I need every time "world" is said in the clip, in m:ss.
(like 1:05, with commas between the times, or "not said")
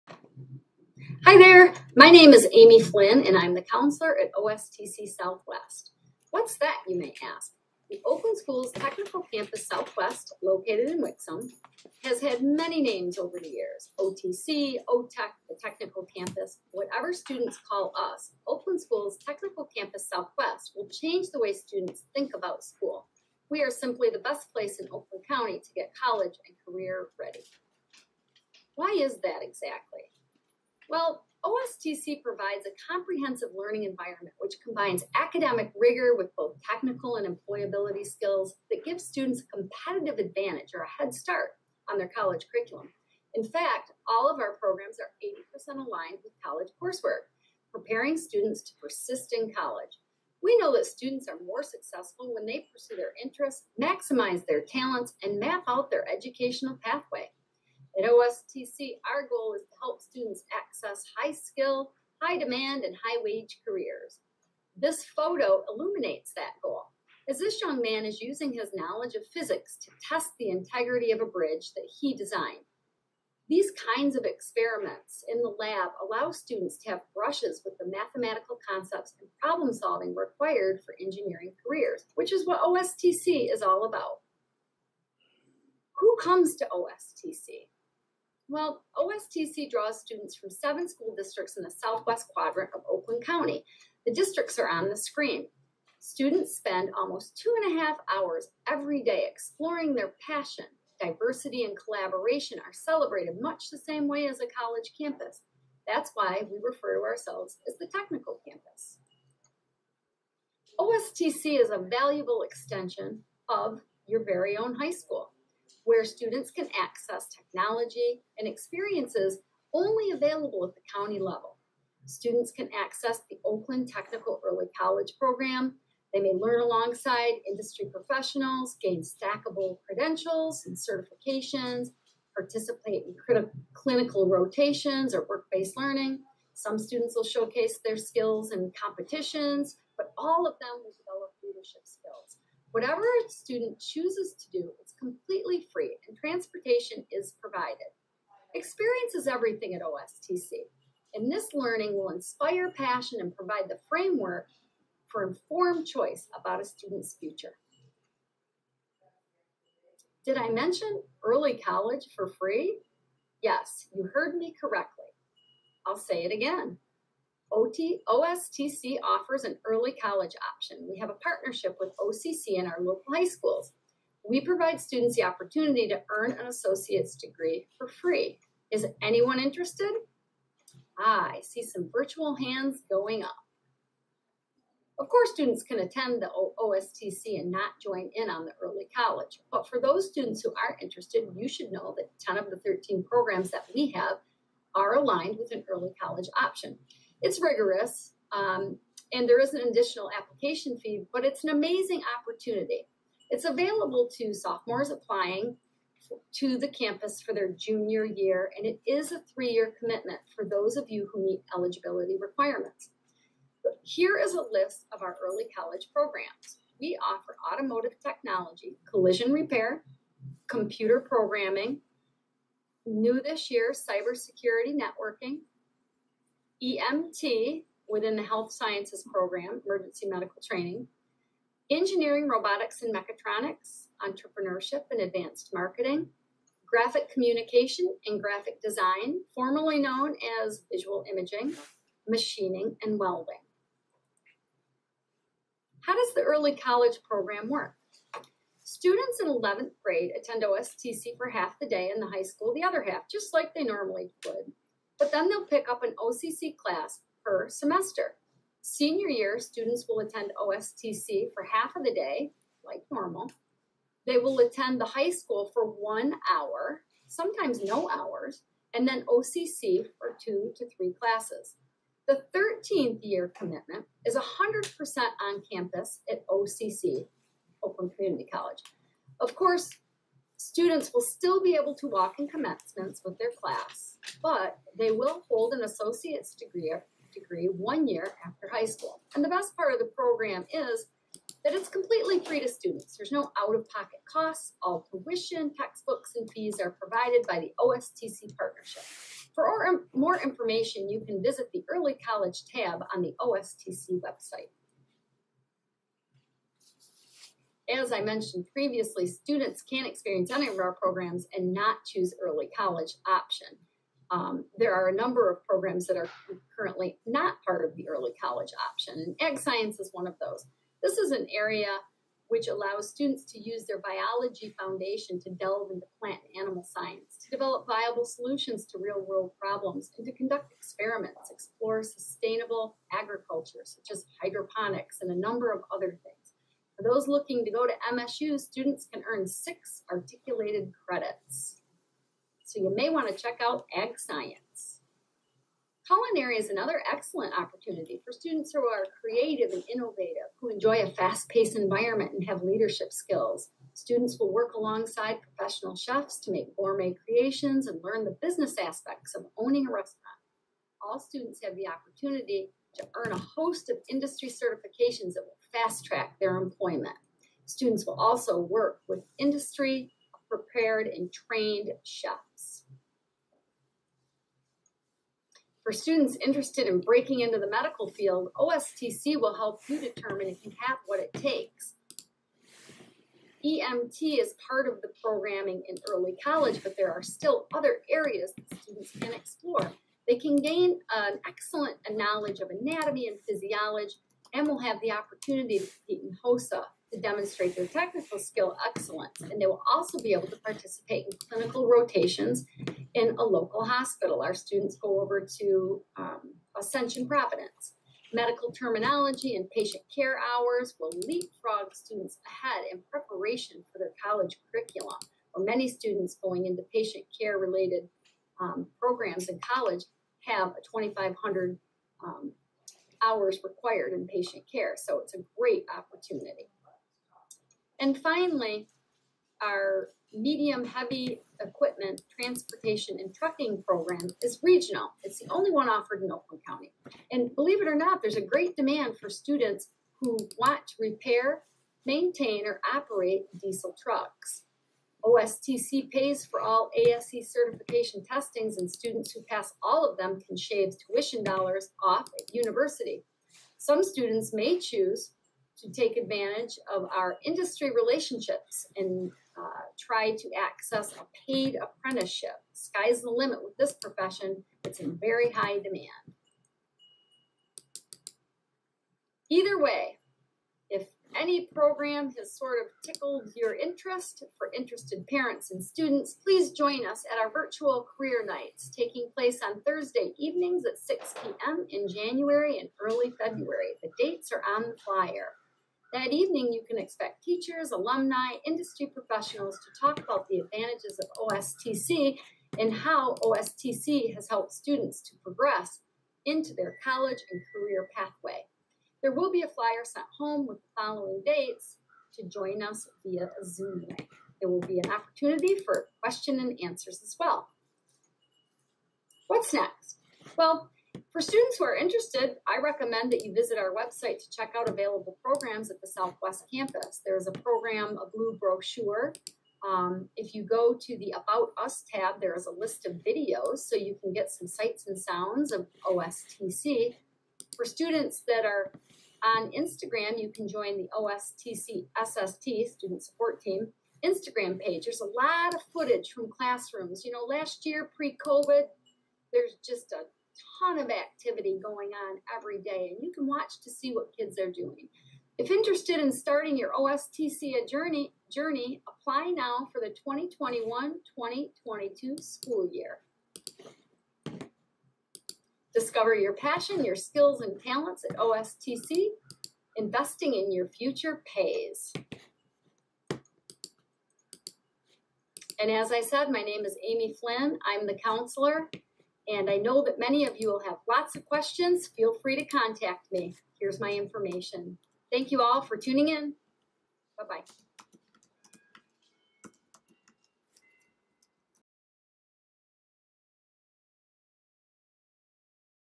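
5:29.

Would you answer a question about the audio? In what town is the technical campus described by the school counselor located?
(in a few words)
Wixom.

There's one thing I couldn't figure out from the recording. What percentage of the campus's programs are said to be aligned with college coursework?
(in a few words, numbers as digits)
80%.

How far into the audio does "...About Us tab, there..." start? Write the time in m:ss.
8:41.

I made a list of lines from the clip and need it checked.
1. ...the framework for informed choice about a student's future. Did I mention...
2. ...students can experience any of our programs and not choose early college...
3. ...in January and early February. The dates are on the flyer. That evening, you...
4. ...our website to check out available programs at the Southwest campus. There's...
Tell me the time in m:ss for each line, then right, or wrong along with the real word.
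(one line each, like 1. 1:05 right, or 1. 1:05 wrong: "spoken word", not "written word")
1. 2:33 right
2. 5:09 right
3. 8:01 right
4. 8:33 right.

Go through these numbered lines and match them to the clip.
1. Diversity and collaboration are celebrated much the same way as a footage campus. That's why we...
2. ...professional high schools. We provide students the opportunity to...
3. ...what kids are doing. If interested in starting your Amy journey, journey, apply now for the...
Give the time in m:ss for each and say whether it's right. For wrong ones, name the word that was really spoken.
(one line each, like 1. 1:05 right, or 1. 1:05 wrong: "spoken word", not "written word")
1. 1:40 wrong: "college", not "footage"
2. 2:52 wrong: "local", not "professional"
3. 9:03 wrong: "OSTC", not "Amy".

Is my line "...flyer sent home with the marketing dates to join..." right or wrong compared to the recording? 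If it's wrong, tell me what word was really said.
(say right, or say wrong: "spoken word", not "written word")
wrong: "following", not "marketing".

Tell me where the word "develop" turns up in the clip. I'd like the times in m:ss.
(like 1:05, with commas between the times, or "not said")
2:20, 5:27.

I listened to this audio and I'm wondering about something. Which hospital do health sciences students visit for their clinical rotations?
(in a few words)
Ascension Providence.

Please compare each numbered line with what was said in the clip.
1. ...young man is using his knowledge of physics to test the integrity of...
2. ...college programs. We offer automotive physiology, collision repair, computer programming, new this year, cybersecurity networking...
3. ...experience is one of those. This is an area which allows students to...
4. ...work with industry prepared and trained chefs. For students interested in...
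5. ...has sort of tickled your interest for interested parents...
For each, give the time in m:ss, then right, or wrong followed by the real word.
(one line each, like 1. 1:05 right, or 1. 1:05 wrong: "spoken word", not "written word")
1. 1:07 right
2. 3:35 wrong: "technology", not "physiology"
3. 5:19 wrong: "science", not "experience"
4. 6:08 right
5. 7:52 right.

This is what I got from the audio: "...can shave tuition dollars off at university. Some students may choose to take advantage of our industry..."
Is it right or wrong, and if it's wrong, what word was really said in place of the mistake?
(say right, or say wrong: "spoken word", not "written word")
right.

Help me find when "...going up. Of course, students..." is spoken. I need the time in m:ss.
3:02.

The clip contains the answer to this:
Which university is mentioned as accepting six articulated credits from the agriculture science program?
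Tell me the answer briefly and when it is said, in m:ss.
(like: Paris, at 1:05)
MSU, at 5:37.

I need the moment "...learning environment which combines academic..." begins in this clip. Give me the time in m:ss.
0:33.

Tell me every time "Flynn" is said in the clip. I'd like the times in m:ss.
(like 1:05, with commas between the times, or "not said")
0:02, 9:27.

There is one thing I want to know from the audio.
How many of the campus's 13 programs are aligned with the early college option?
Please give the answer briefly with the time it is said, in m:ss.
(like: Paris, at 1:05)
10, at 3:12.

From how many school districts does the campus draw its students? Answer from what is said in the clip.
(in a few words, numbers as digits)
7.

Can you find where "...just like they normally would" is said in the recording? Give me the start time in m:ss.
4:13.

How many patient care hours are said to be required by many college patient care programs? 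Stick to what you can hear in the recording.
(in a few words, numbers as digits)
2,500.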